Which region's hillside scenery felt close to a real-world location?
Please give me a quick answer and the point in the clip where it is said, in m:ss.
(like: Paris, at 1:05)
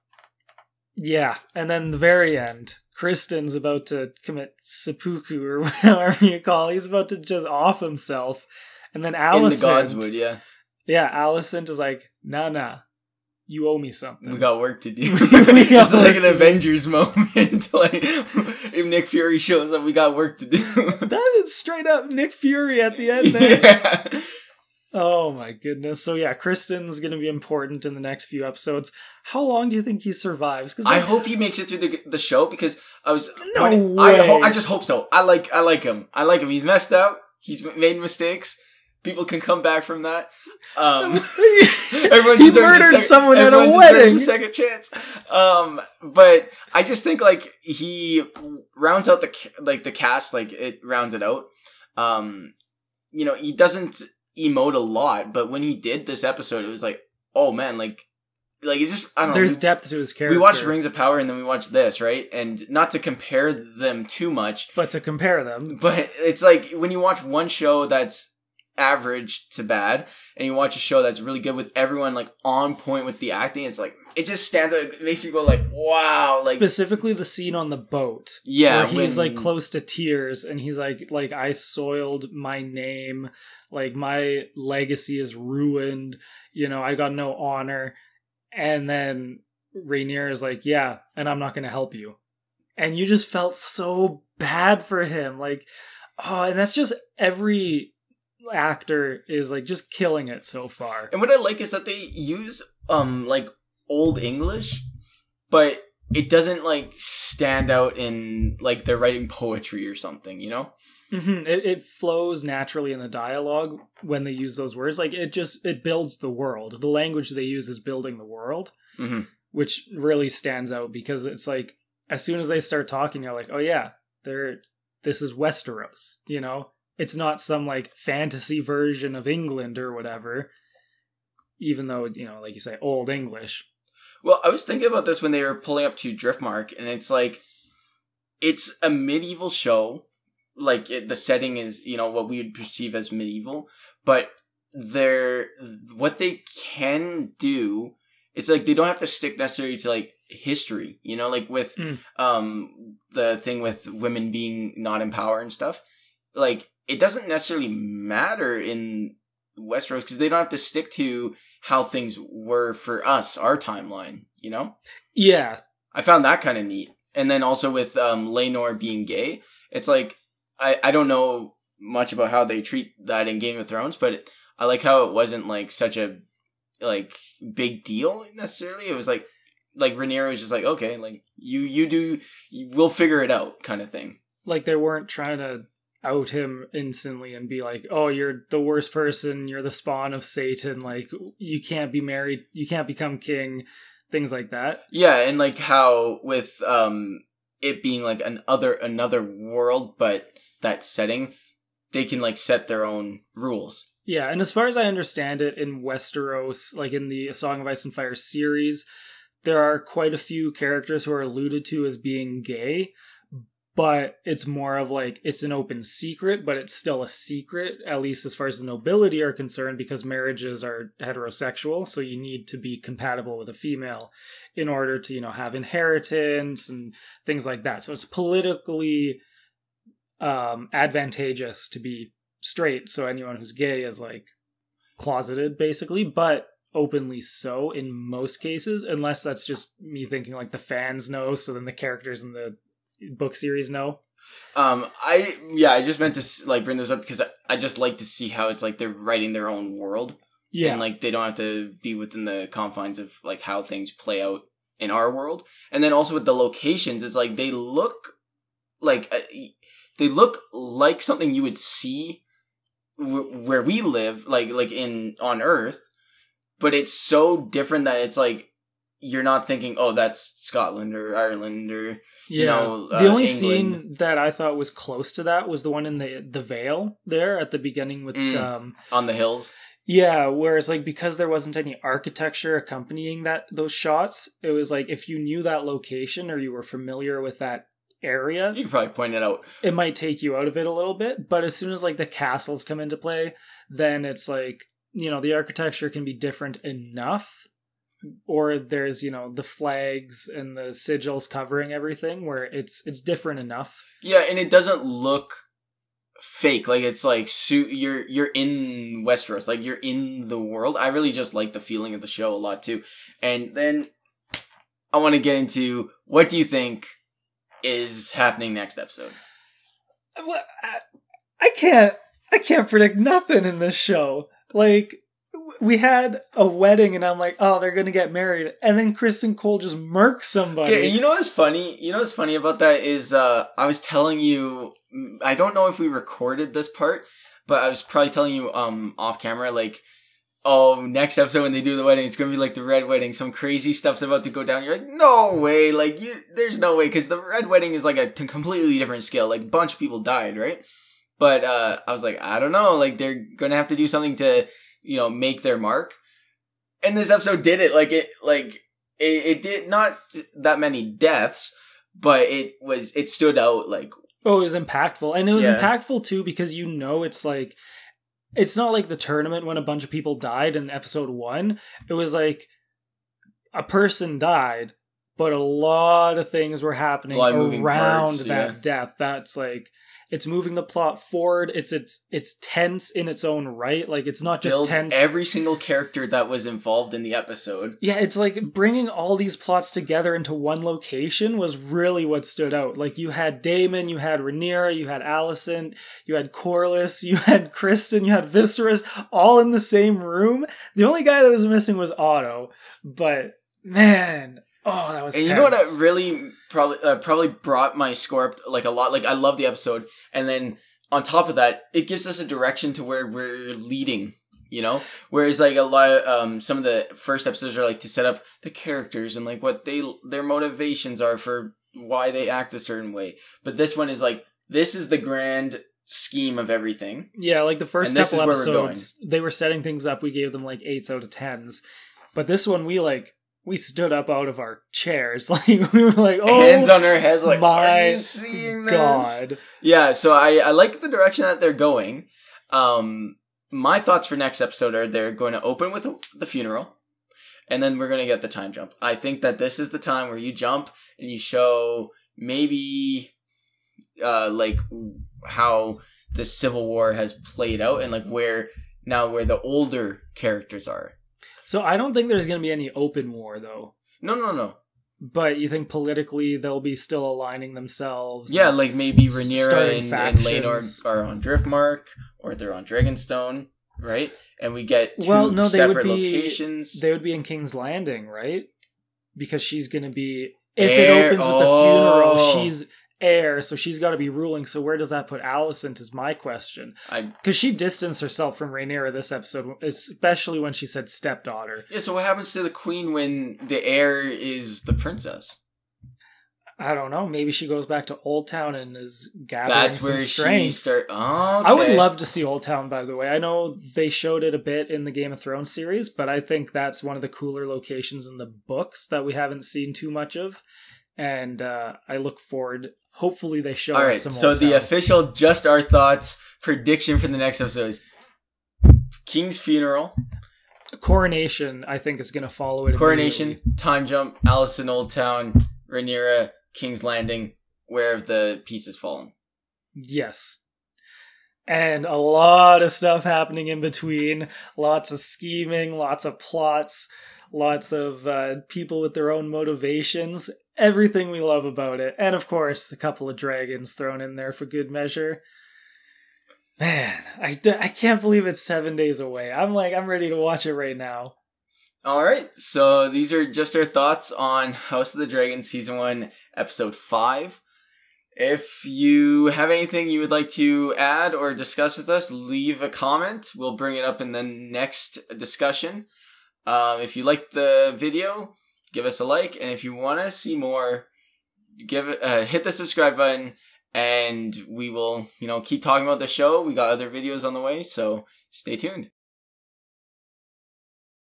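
The Vale, at 4:36.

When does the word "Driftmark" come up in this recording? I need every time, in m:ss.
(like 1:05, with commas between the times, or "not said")
2:16, 7:51.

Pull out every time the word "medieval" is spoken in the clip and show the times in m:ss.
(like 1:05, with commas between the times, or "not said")
2:18, 2:23.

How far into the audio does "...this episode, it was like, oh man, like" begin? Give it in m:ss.
0:56.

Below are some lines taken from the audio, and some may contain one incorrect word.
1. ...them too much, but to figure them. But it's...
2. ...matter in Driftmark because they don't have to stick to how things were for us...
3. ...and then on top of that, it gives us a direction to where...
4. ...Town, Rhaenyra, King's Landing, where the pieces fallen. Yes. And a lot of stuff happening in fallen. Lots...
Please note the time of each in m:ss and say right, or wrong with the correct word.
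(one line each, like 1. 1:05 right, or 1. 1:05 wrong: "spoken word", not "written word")
1. 1:03 wrong: "compare", not "figure"
2. 2:37 wrong: "Westeros", not "Driftmark"
3. 6:50 right
4. 8:44 wrong: "between", not "fallen".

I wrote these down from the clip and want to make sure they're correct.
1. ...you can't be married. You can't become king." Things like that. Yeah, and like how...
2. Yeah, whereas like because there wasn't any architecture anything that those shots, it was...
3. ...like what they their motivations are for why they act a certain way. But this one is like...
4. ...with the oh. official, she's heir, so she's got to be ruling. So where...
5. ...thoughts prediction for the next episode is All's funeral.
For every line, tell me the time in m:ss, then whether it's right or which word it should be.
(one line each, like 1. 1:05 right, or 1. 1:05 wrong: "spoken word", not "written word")
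1. 3:11 right
2. 4:39 wrong: "accompanying", not "anything"
3. 6:59 right
4. 8:01 wrong: "funeral", not "official"
5. 8:35 wrong: "King", not "All".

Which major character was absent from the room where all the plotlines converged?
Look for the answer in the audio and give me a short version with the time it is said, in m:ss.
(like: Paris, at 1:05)
Otto, at 6:41.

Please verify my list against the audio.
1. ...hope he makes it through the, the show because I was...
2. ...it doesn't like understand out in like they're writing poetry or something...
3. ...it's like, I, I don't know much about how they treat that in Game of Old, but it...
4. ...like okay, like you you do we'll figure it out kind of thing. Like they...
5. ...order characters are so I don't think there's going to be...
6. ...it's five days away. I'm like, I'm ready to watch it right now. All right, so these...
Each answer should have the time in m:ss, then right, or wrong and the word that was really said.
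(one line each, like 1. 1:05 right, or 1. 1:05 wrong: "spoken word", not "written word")
1. 0:31 right
2. 1:46 wrong: "stand", not "understand"
3. 2:49 wrong: "Thrones", not "Old"
4. 3:00 right
5. 7:39 wrong: "older", not "order"
6. 9:08 wrong: "seven", not "five".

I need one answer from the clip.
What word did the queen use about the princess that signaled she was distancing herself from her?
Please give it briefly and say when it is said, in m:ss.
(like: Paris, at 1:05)
stepdaughter, at 8:10.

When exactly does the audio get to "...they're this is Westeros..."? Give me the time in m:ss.
2:04.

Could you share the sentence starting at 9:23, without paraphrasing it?
We'll bring it up in the next discussion.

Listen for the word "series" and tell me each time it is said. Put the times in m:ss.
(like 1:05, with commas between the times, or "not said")
3:28, 4:03, 8:25.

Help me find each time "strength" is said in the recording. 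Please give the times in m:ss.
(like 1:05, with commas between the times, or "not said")
8:20.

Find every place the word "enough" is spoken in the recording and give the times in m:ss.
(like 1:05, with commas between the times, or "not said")
4:56, 5:03.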